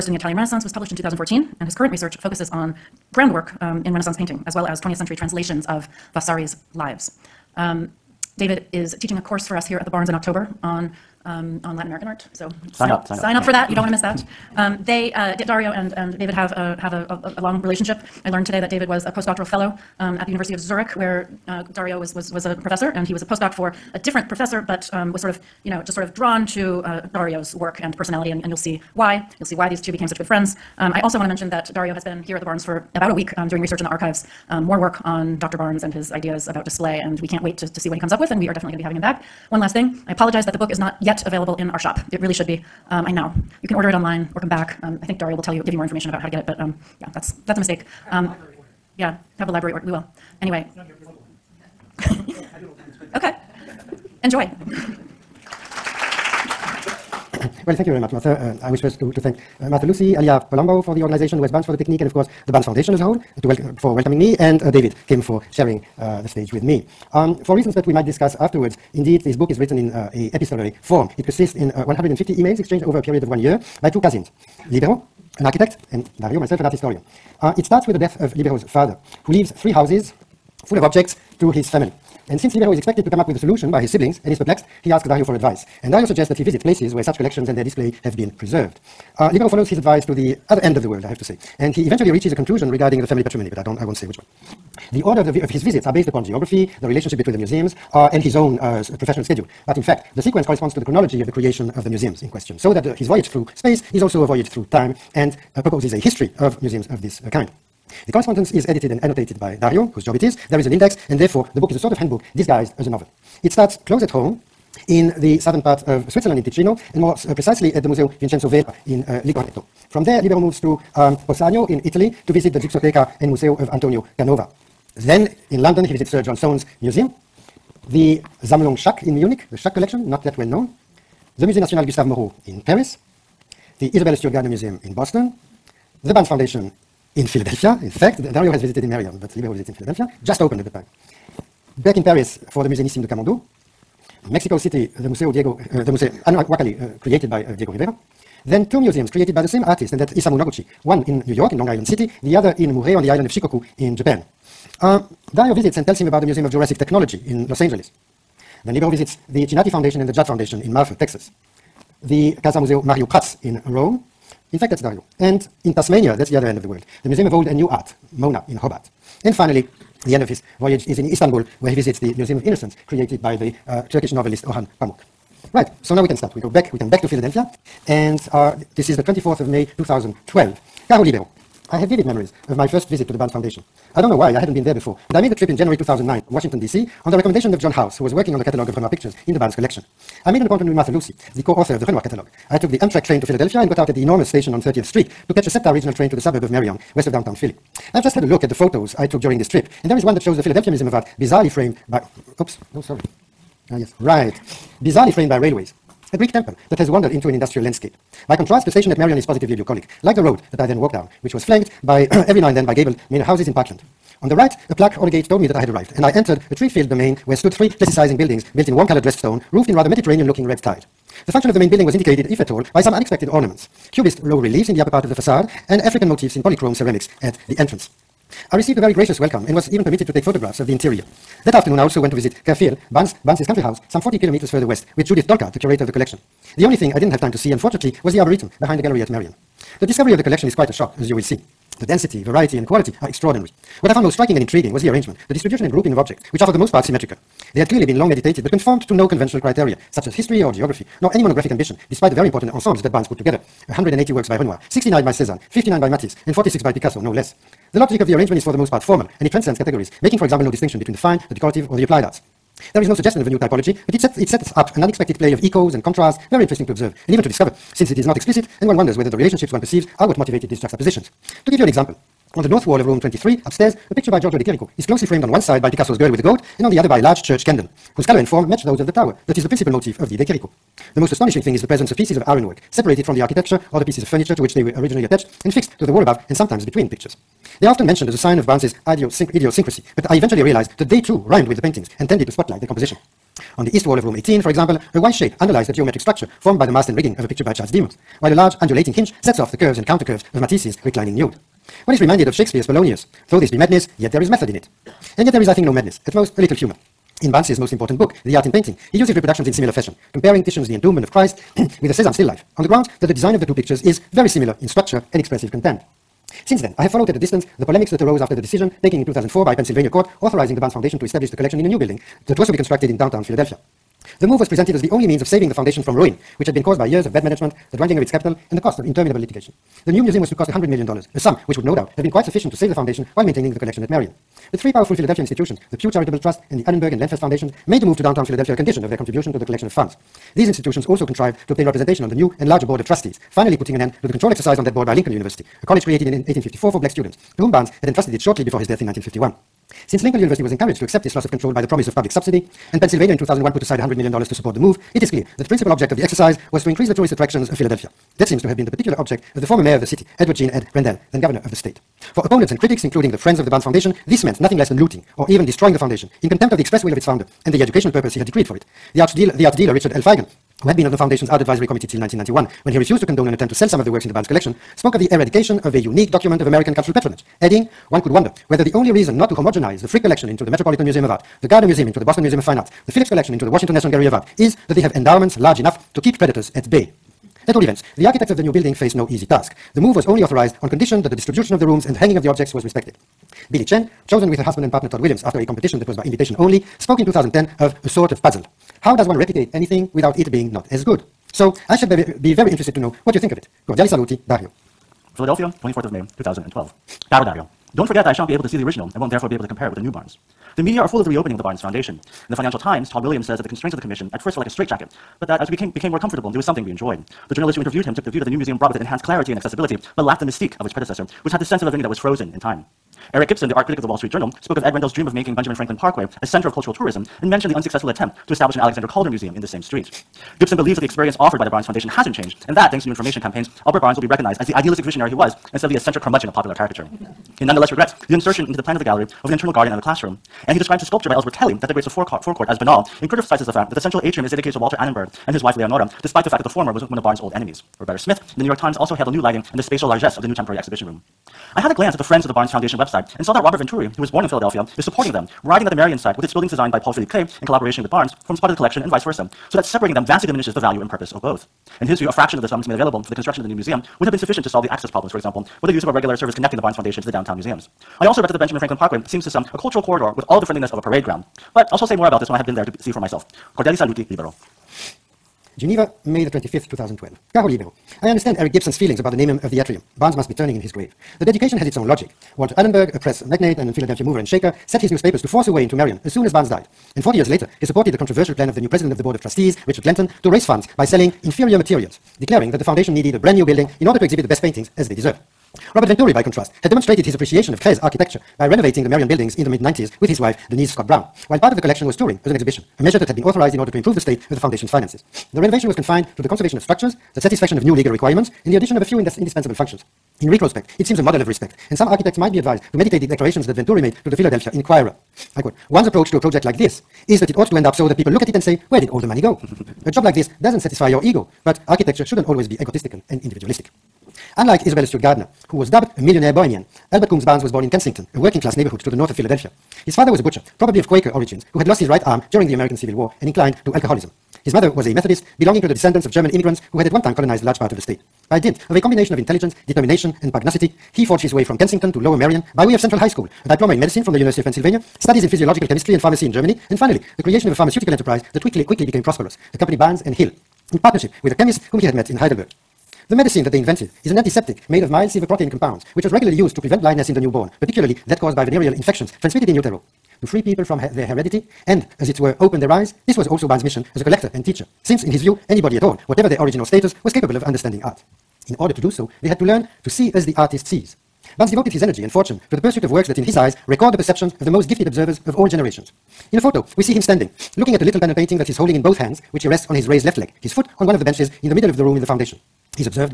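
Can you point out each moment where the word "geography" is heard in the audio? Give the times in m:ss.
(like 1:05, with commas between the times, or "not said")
1:36, 4:10.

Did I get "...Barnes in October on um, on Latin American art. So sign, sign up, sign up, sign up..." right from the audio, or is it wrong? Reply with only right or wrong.
right.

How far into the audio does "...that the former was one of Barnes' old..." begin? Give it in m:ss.
7:26.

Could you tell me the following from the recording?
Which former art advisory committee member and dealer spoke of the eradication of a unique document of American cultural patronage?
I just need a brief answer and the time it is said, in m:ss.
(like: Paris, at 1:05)
Richard L. Feigen, at 6:09.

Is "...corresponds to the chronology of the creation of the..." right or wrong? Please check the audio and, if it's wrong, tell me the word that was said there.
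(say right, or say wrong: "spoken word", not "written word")
right.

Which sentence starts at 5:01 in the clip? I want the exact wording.
One is reminded of Shakespeare's Polonius.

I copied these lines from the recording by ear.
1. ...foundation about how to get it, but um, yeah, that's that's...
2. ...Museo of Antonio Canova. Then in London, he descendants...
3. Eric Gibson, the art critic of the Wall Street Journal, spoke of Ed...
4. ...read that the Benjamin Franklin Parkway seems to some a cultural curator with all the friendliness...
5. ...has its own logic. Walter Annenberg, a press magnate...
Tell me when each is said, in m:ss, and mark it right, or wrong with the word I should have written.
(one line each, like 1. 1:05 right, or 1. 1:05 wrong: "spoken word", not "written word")
1. 0:45 wrong: "information", not "foundation"
2. 2:03 wrong: "visits", not "descendants"
3. 7:03 right
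4. 7:48 wrong: "corridor", not "curator"
5. 8:01 right.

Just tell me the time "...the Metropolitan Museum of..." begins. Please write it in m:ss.
6:20.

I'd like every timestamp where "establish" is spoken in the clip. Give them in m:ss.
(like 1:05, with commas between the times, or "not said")
5:21, 7:08.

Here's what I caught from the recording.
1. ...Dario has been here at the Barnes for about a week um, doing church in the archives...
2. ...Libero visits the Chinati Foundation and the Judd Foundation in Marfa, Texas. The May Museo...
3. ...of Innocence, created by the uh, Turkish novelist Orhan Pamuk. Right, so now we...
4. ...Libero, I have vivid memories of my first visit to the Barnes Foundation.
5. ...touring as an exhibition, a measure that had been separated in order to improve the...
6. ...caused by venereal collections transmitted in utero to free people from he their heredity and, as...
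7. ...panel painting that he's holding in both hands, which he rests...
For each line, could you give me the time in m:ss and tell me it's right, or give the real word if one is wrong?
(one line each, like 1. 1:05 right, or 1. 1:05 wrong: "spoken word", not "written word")
1. 0:31 wrong: "research", not "church"
2. 2:38 wrong: "Casa", not "May"
3. 2:52 right
4. 3:01 right
5. 8:21 wrong: "authorized", not "separated"
6. 9:18 wrong: "infections", not "collections"
7. 9:37 right.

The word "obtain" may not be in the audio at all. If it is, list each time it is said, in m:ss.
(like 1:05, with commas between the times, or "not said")
5:41.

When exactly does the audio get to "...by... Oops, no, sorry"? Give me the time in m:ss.
3:21.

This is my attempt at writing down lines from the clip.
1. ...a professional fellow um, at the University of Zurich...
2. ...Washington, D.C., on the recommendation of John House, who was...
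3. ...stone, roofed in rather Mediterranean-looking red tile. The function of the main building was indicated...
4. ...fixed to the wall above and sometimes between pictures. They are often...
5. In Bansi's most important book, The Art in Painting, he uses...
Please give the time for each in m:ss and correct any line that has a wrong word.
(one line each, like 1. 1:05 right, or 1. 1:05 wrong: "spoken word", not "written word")
1. 0:19 wrong: "postdoctoral", not "professional"
2. 3:06 right
3. 3:39 right
4. 4:45 right
5. 5:07 right.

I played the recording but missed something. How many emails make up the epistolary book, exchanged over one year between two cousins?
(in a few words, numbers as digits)
150.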